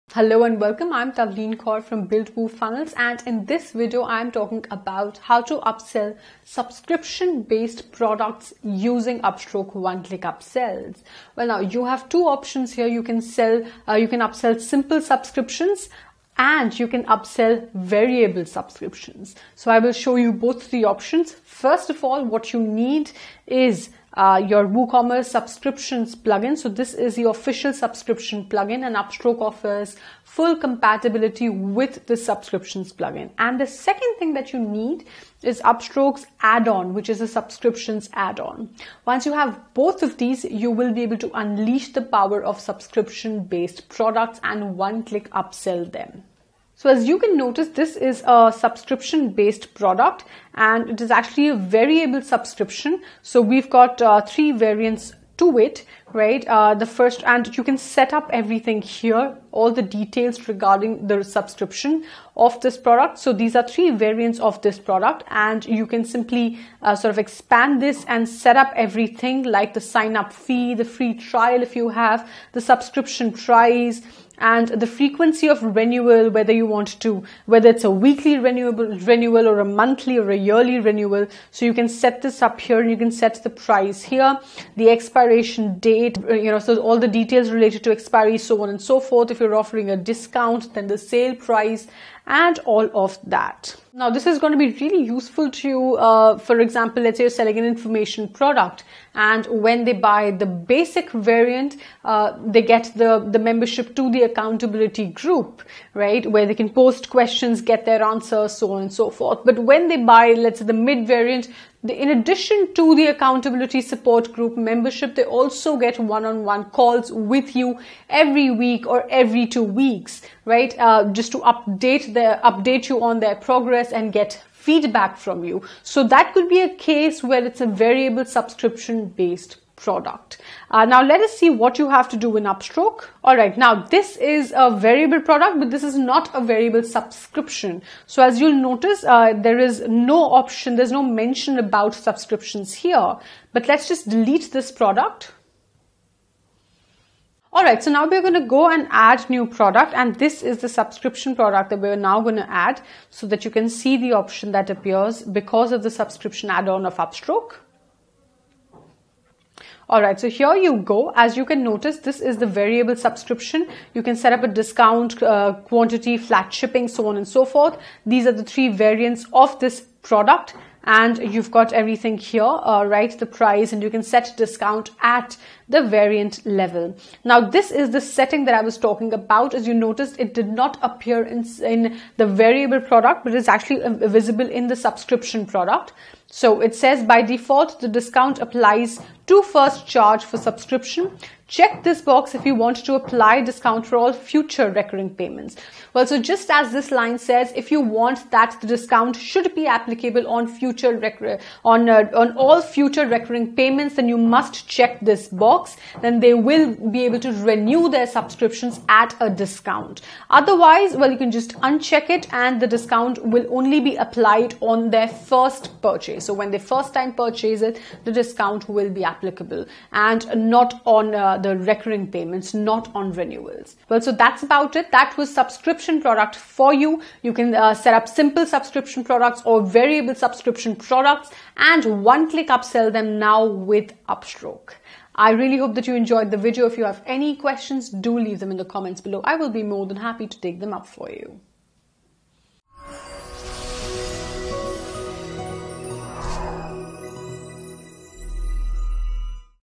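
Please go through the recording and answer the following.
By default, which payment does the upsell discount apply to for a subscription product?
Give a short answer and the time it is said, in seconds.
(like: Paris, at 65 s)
first charge, at 189 s.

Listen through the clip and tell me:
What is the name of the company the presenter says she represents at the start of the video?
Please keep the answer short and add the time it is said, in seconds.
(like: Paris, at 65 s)
Build Woo Funnels, at 2 s.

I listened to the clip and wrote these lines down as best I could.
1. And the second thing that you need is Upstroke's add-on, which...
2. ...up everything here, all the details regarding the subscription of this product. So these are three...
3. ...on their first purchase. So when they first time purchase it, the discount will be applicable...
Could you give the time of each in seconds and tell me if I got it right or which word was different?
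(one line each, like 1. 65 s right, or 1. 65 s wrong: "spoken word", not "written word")
1. 33 s right
2. 58 s right
3. 214 s right.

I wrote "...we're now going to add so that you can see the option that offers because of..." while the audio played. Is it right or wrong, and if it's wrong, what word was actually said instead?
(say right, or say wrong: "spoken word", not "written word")
wrong: "appears", not "offers".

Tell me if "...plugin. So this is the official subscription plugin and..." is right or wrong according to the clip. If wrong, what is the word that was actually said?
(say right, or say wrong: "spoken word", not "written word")
right.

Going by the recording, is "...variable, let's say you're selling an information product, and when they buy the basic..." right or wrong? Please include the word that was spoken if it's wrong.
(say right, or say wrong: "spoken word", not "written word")
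wrong: "example", not "variable".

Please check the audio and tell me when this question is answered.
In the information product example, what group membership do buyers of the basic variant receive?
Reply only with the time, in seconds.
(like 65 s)
104 s.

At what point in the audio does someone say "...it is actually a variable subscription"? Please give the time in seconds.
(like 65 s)
50 s.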